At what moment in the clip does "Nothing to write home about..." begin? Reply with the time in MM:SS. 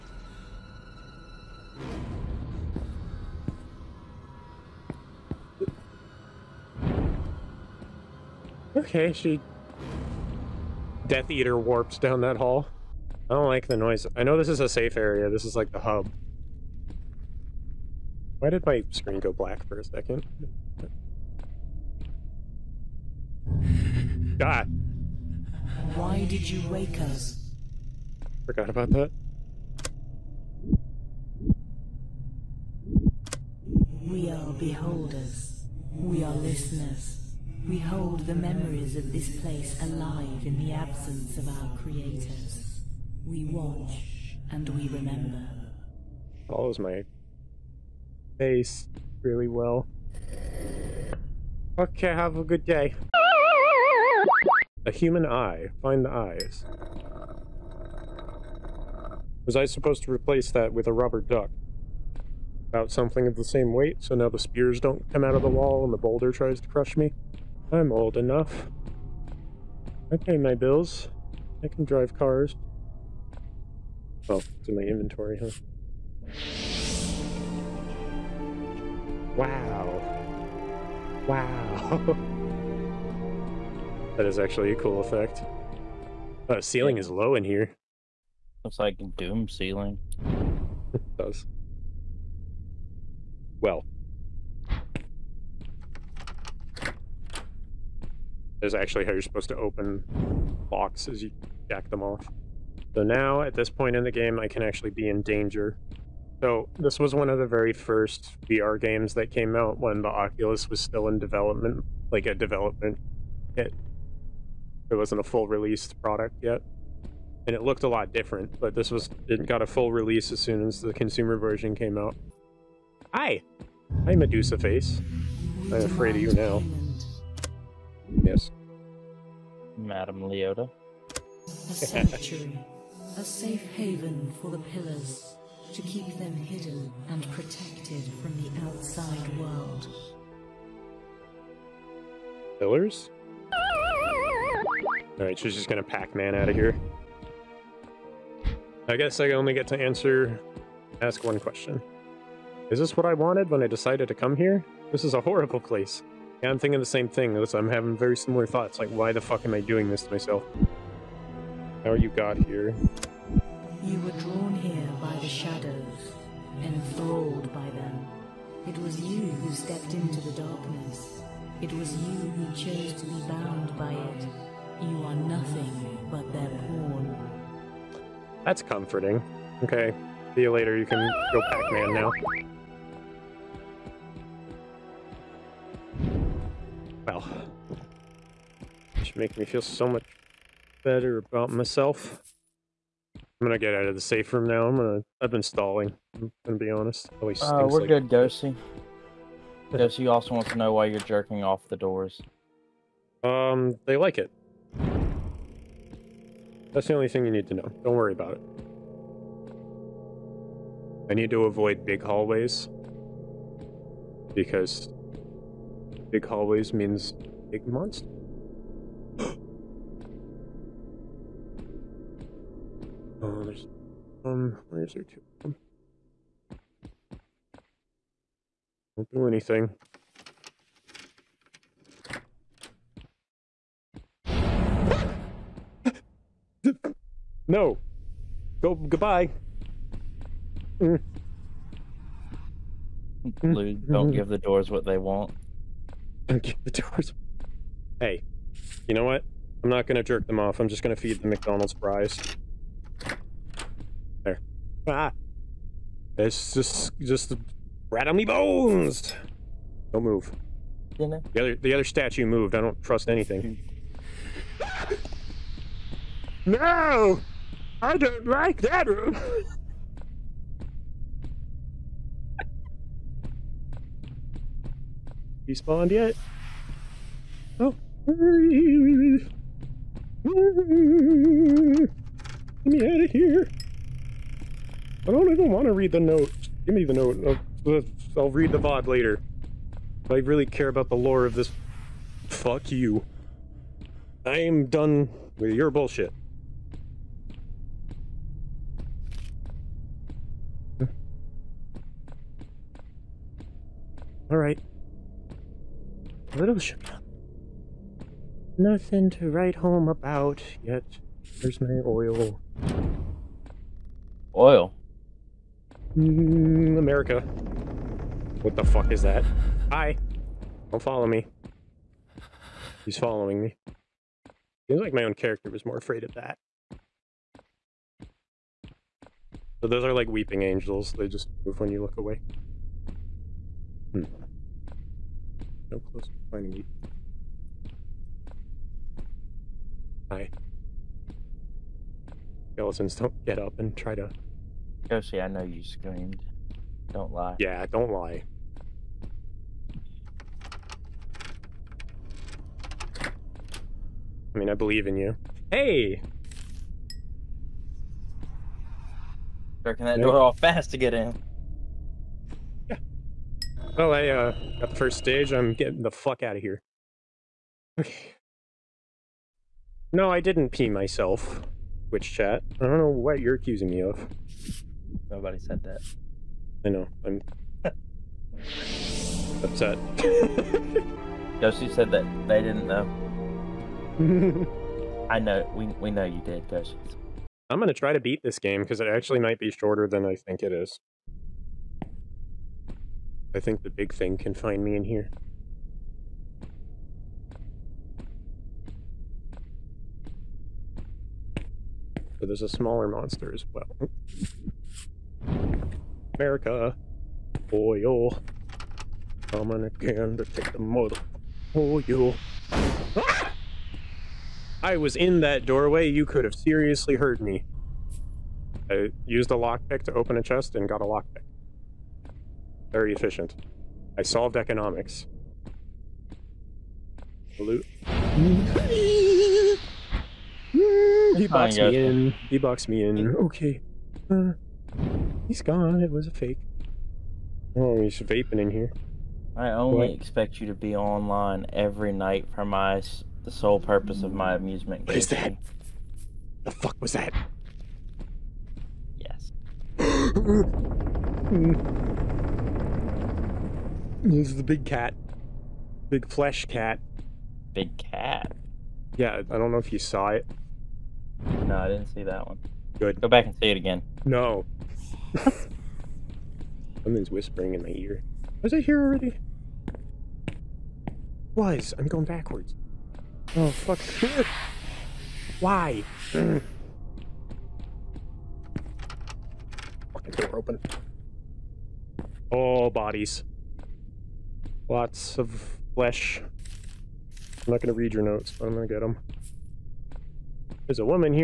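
05:08.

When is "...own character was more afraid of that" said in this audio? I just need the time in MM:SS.
05:25.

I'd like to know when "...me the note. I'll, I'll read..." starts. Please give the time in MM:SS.
04:46.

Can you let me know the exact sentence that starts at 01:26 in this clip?
The uh, ceiling is low in here.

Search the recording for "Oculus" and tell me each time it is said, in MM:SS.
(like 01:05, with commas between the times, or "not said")
01:50.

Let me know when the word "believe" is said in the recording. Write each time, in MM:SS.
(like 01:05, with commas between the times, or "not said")
05:54.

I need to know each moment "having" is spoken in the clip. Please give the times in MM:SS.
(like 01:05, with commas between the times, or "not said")
02:37.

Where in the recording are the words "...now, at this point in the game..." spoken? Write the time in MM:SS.
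01:43.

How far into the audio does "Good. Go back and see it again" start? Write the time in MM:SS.
07:42.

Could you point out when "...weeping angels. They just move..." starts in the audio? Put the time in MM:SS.
05:30.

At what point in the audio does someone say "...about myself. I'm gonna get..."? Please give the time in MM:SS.
03:11.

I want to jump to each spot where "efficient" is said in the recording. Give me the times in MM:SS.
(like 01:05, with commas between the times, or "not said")
07:02.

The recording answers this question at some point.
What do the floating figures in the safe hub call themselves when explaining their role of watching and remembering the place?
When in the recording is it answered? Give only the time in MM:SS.
00:34.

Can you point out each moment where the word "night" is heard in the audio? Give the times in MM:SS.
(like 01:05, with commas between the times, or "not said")
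07:21.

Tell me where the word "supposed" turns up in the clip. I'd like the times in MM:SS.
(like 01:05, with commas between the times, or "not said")
00:59, 01:39.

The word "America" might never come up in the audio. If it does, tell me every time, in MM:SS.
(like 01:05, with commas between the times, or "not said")
05:16, 06:46.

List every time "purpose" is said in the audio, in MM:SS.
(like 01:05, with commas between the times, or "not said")
07:23.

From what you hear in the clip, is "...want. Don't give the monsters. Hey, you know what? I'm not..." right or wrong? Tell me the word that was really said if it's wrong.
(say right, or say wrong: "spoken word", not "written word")
wrong: "doors", not "monsters".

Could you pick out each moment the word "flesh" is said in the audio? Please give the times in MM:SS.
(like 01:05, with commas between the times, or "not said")
07:36, 08:05.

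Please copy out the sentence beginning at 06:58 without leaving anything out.
I used a lockpick to open a chest and got a lockpick.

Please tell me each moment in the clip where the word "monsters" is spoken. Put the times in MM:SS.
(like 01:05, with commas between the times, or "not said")
03:37, 06:42.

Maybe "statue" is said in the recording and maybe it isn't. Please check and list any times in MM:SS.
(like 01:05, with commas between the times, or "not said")
04:21.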